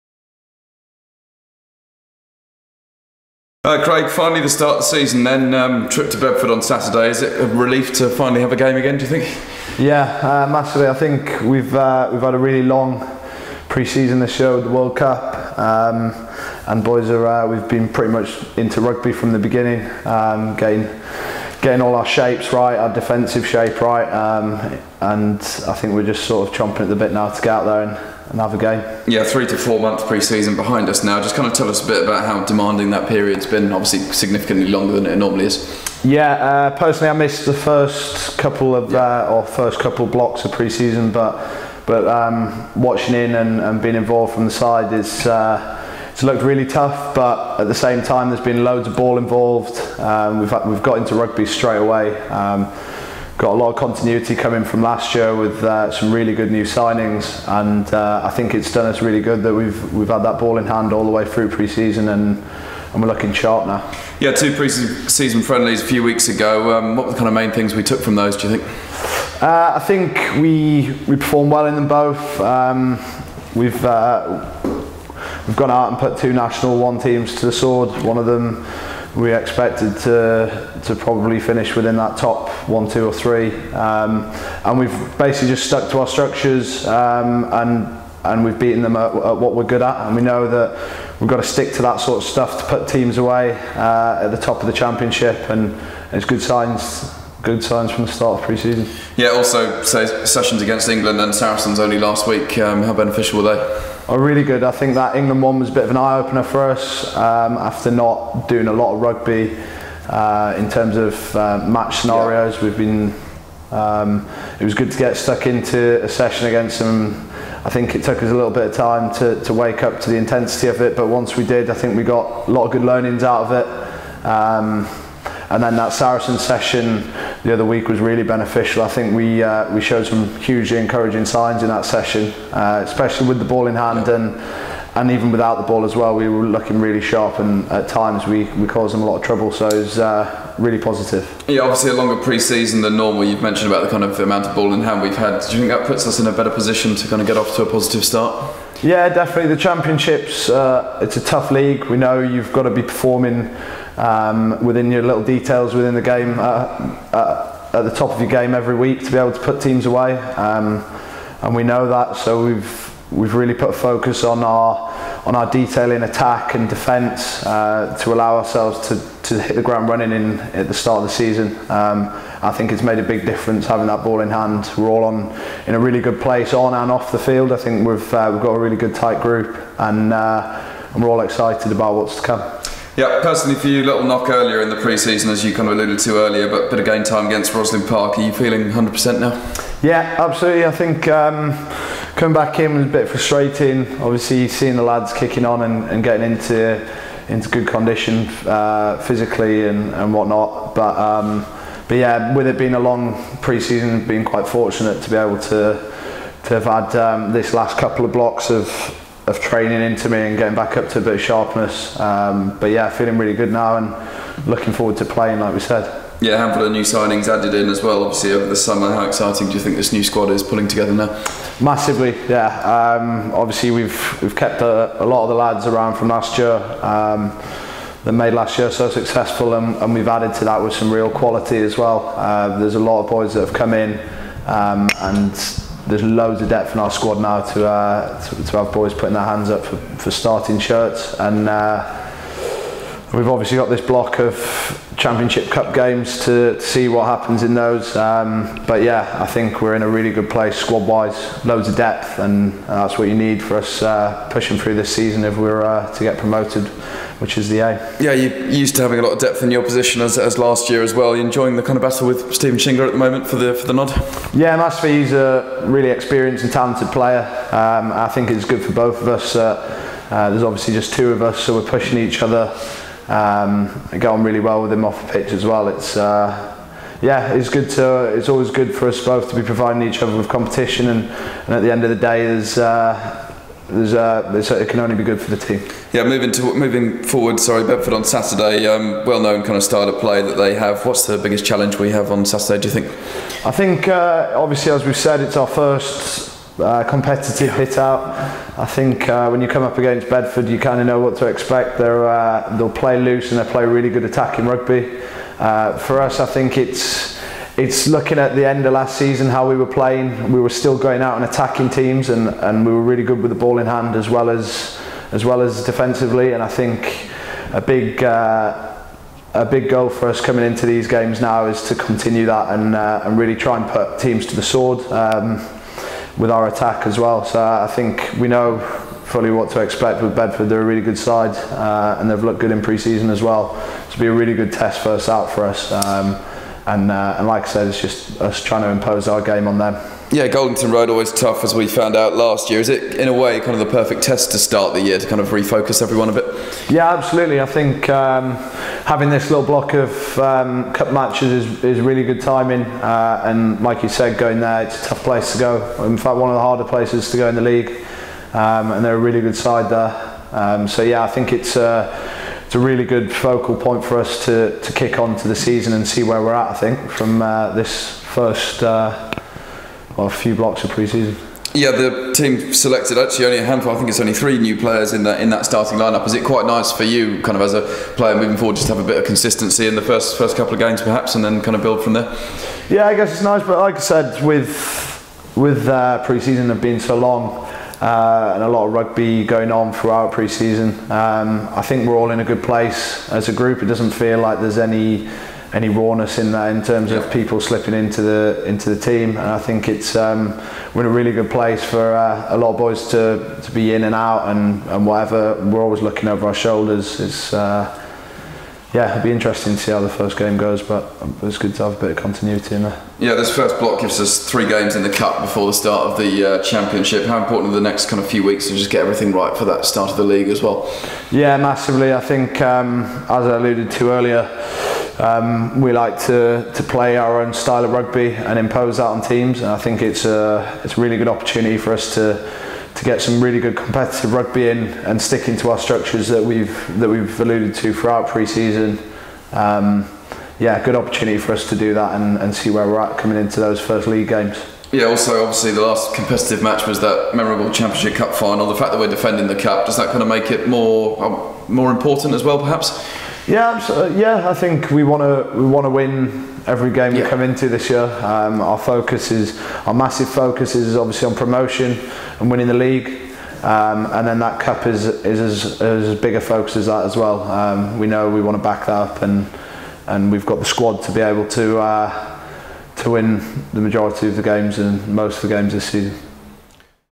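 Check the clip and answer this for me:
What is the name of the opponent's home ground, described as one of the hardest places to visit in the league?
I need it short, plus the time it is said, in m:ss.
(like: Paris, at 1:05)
Goldington Road, at 5:40.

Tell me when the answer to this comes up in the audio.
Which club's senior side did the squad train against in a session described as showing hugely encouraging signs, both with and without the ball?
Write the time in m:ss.
1:41.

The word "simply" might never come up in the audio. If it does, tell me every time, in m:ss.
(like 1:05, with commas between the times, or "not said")
not said.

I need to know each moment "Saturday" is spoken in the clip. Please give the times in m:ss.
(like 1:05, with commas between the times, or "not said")
0:06, 4:48, 4:52.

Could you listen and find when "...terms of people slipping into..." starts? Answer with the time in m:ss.
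6:36.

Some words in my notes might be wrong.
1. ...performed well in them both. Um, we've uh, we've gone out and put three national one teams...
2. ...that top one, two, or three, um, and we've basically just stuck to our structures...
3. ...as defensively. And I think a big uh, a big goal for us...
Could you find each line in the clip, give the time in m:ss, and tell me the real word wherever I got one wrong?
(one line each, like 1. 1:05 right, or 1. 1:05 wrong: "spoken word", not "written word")
1. 1:11 wrong: "two", not "three"
2. 1:21 right
3. 5:15 right.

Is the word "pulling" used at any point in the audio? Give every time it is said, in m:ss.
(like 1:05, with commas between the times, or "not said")
3:40.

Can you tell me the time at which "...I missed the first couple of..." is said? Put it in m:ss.
0:37.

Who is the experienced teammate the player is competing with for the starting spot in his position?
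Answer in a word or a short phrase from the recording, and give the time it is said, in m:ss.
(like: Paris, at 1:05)
Stephen Shingler, at 4:22.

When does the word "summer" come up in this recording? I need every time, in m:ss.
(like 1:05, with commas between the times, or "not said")
3:38.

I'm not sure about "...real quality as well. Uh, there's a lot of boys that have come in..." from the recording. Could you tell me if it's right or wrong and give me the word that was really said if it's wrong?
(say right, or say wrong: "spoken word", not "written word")
right.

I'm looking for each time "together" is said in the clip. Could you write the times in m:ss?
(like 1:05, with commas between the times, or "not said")
3:40.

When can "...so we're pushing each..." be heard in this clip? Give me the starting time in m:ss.
4:31.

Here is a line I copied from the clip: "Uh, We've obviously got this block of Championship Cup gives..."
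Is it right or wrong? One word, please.
wrong.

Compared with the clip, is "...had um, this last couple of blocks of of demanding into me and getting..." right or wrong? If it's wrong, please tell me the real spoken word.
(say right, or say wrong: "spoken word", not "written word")
wrong: "training", not "demanding".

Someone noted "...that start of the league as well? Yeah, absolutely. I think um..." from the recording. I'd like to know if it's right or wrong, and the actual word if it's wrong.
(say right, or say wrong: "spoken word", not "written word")
wrong: "massively", not "absolutely".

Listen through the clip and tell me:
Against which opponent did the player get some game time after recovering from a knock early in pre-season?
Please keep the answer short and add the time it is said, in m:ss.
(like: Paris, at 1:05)
Rosslyn Park, at 3:07.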